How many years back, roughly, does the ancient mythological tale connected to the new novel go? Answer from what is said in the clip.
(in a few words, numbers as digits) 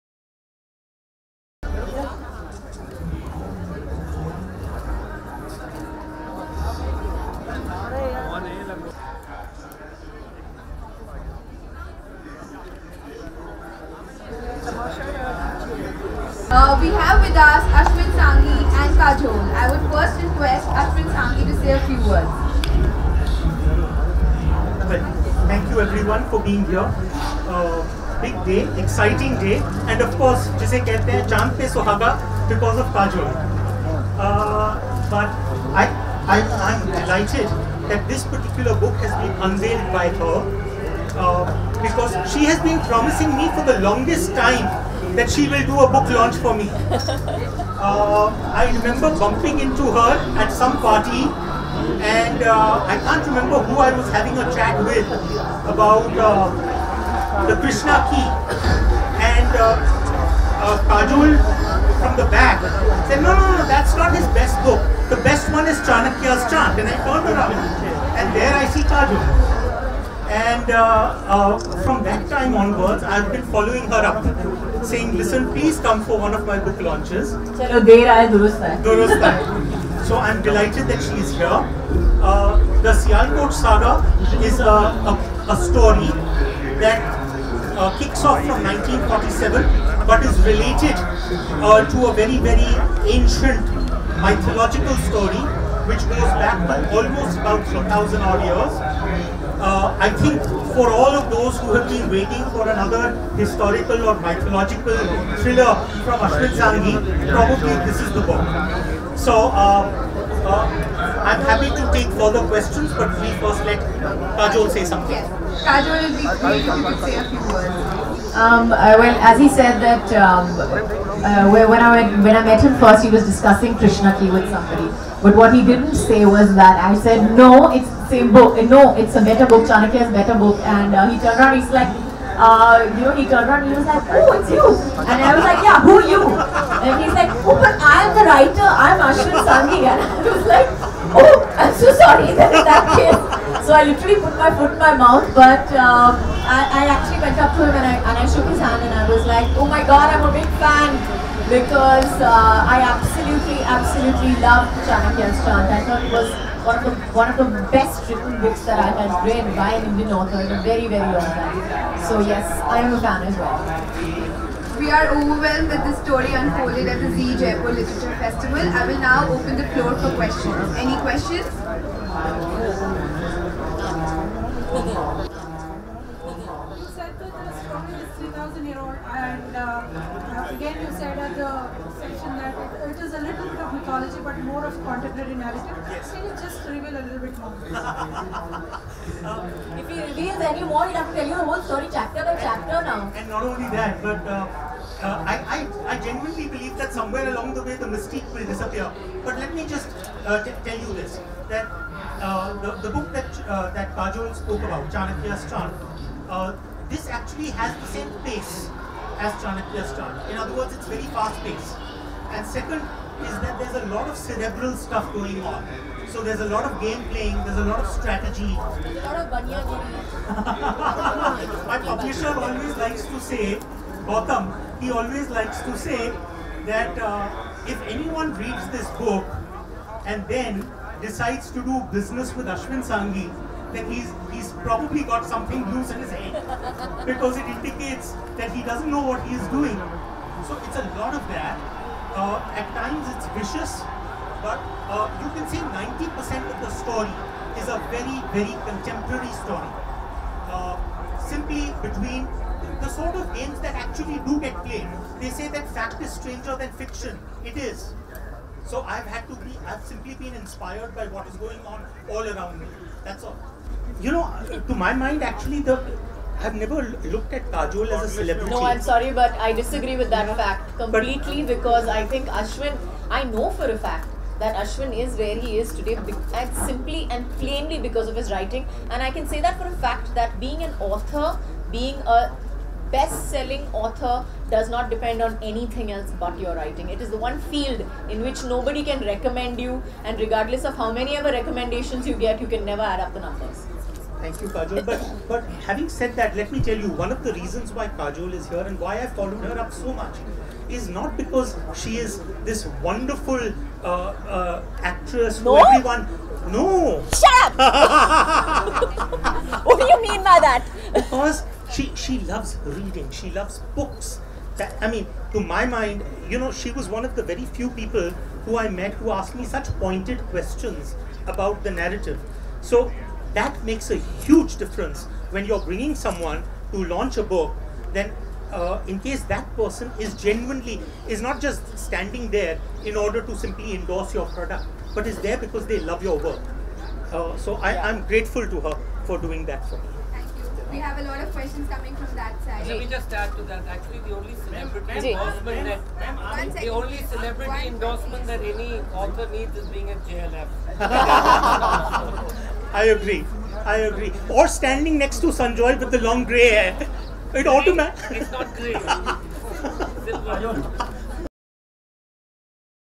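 4,000.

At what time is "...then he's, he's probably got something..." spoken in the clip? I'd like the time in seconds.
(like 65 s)
233 s.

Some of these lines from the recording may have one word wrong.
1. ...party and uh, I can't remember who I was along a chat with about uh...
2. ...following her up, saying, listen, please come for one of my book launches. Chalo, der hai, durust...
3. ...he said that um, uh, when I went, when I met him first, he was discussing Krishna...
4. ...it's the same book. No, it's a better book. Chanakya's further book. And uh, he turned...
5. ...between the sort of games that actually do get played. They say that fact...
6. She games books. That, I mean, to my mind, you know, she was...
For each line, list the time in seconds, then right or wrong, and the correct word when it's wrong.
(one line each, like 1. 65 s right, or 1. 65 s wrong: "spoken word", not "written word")
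1. 50 s wrong: "having", not "along"
2. 73 s right
3. 119 s right
4. 127 s wrong: "better", not "further"
5. 251 s right
6. 313 s wrong: "loves", not "games".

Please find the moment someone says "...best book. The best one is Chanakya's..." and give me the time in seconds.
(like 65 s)
64 s.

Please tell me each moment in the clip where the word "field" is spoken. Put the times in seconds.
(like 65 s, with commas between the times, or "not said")
287 s.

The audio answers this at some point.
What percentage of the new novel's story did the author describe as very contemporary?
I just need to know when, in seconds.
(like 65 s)
245 s.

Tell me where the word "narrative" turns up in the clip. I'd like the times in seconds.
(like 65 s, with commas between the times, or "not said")
185 s, 321 s.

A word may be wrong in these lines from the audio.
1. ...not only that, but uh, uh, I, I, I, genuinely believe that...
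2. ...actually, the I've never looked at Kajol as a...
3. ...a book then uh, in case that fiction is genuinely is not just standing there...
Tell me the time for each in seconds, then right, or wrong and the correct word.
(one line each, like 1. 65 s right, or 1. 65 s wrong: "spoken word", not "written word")
1. 193 s right
2. 265 s right
3. 327 s wrong: "person", not "fiction".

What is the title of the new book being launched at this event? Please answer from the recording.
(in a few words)
The Sialkot Saga.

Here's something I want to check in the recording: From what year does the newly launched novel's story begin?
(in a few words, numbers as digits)
1947.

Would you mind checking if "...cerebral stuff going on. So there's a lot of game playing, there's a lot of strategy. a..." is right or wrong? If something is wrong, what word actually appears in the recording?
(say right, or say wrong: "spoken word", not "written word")
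right.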